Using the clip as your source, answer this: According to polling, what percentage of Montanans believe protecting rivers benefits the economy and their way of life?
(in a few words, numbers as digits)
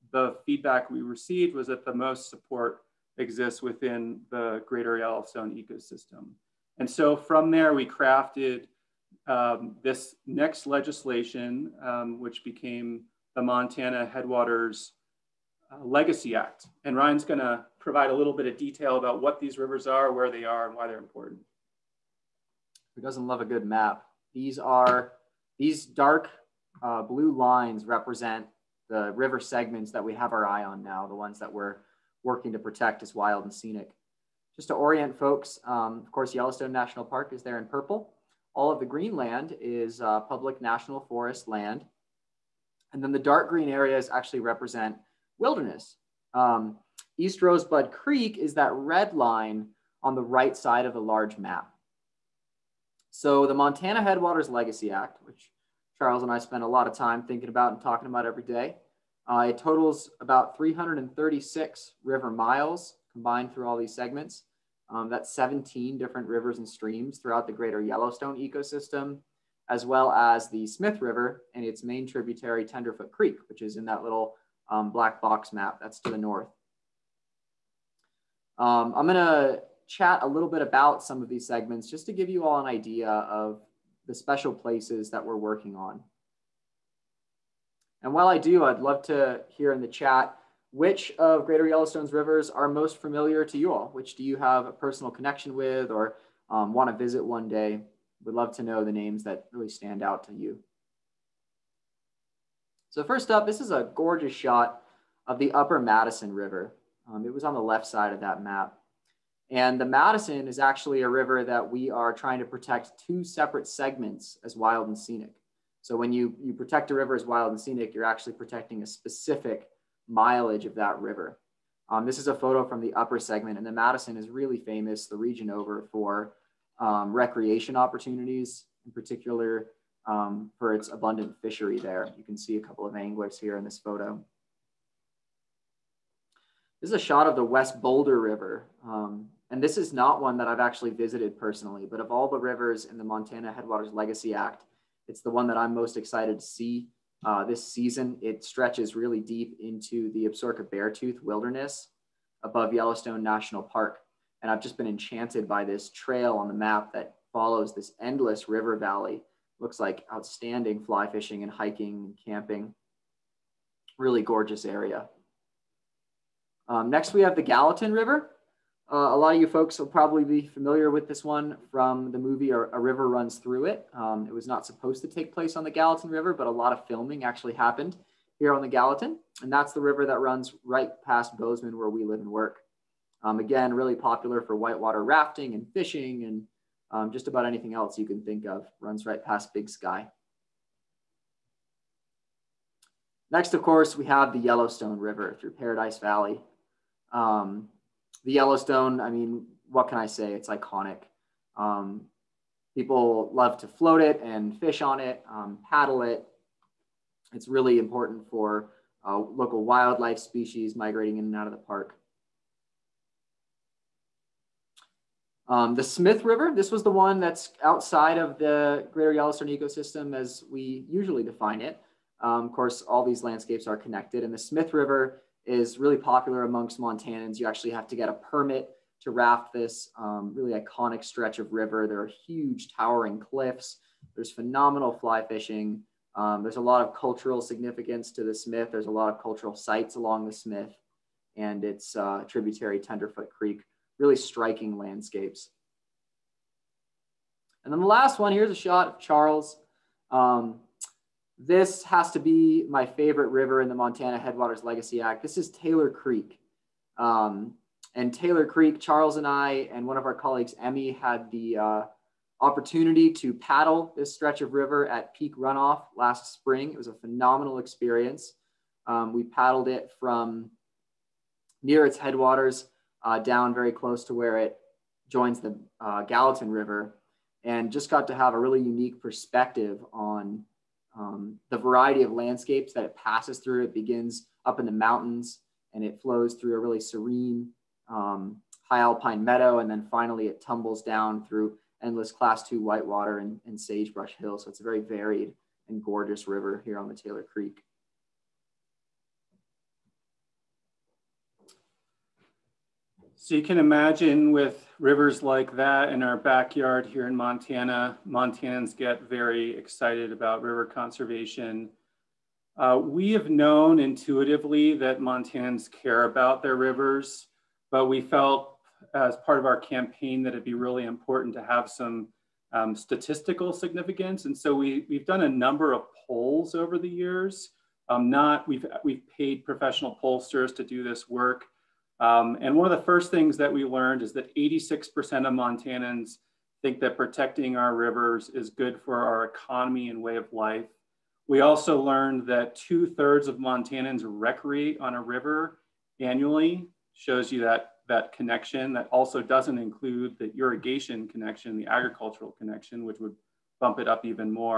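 86%.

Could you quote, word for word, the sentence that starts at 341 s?
We also learned that two thirds of Montanans recreate on a river annually, shows you that, that connection.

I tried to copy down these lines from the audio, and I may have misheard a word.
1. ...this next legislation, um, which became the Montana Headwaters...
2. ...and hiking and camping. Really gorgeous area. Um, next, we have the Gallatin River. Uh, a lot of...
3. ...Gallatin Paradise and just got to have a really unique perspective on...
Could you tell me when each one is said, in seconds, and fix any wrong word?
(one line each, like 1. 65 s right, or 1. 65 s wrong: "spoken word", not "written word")
1. 9 s right
2. 161 s right
3. 276 s wrong: "River", not "Paradise".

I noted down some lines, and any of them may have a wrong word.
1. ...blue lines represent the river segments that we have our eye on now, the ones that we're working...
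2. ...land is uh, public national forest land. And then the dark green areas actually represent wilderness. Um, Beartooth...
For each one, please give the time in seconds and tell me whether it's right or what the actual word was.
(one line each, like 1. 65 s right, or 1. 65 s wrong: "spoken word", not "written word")
1. 27 s right
2. 39 s wrong: "East", not "Beartooth".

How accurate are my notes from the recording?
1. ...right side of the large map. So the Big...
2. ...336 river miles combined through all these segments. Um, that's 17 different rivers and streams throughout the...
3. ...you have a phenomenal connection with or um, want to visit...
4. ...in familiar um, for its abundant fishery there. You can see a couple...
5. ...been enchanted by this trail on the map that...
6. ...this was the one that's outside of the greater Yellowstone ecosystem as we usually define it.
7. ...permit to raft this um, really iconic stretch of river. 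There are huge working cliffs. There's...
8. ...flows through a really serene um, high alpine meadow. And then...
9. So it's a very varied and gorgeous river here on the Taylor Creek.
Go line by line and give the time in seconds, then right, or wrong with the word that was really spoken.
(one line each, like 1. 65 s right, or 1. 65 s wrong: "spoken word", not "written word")
1. 50 s wrong: "Montana", not "Big"
2. 60 s right
3. 94 s wrong: "personal", not "phenomenal"
4. 128 s wrong: "particular", not "familiar"
5. 154 s right
6. 216 s right
7. 228 s wrong: "towering", not "working"
8. 286 s right
9. 294 s right.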